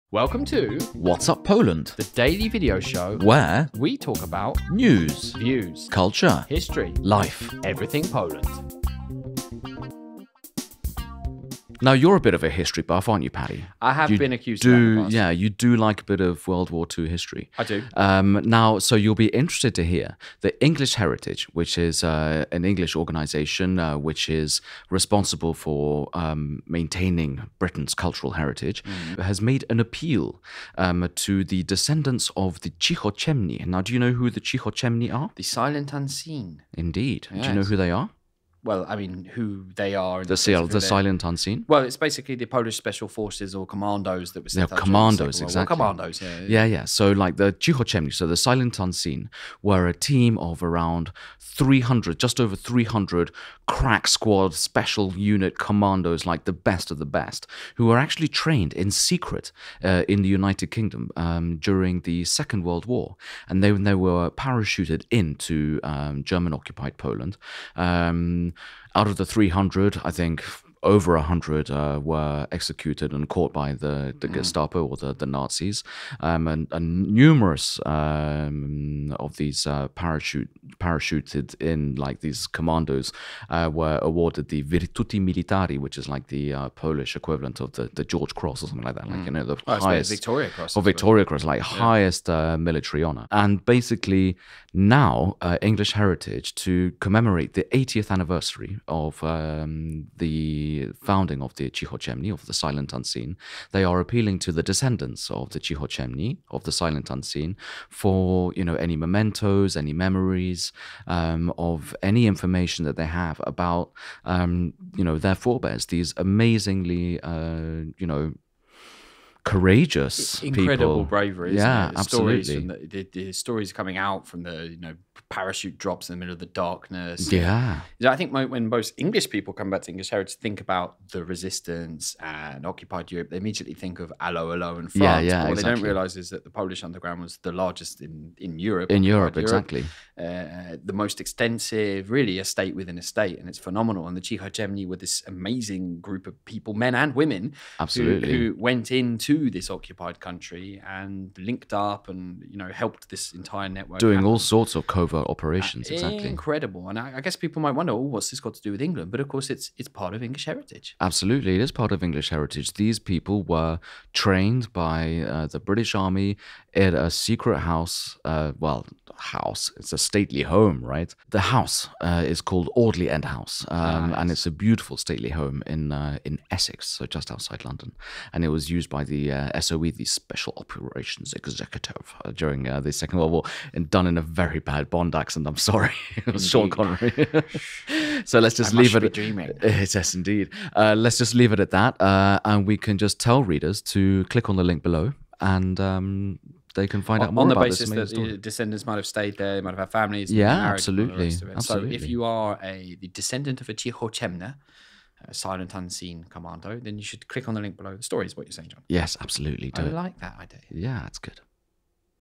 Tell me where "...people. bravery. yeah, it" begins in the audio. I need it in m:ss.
2:00.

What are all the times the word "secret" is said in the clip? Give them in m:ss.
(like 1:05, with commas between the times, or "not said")
0:58, 2:47.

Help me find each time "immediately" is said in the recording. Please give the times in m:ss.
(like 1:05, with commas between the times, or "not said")
2:13.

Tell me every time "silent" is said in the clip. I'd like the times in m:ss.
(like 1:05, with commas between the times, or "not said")
0:35, 0:40, 0:48, 1:42, 1:46, 3:25.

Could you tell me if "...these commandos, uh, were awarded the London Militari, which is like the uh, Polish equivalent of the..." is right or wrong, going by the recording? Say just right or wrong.
wrong.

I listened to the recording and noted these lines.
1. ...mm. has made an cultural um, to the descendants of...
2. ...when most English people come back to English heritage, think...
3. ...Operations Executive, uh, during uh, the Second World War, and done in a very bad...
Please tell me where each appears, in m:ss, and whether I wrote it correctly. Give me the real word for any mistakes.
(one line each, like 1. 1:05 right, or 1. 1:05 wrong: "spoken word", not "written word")
1. 0:28 wrong: "appeal", not "cultural"
2. 2:08 right
3. 3:00 right.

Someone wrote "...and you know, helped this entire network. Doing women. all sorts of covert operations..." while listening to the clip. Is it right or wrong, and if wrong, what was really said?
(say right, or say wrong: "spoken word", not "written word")
wrong: "happen", not "women".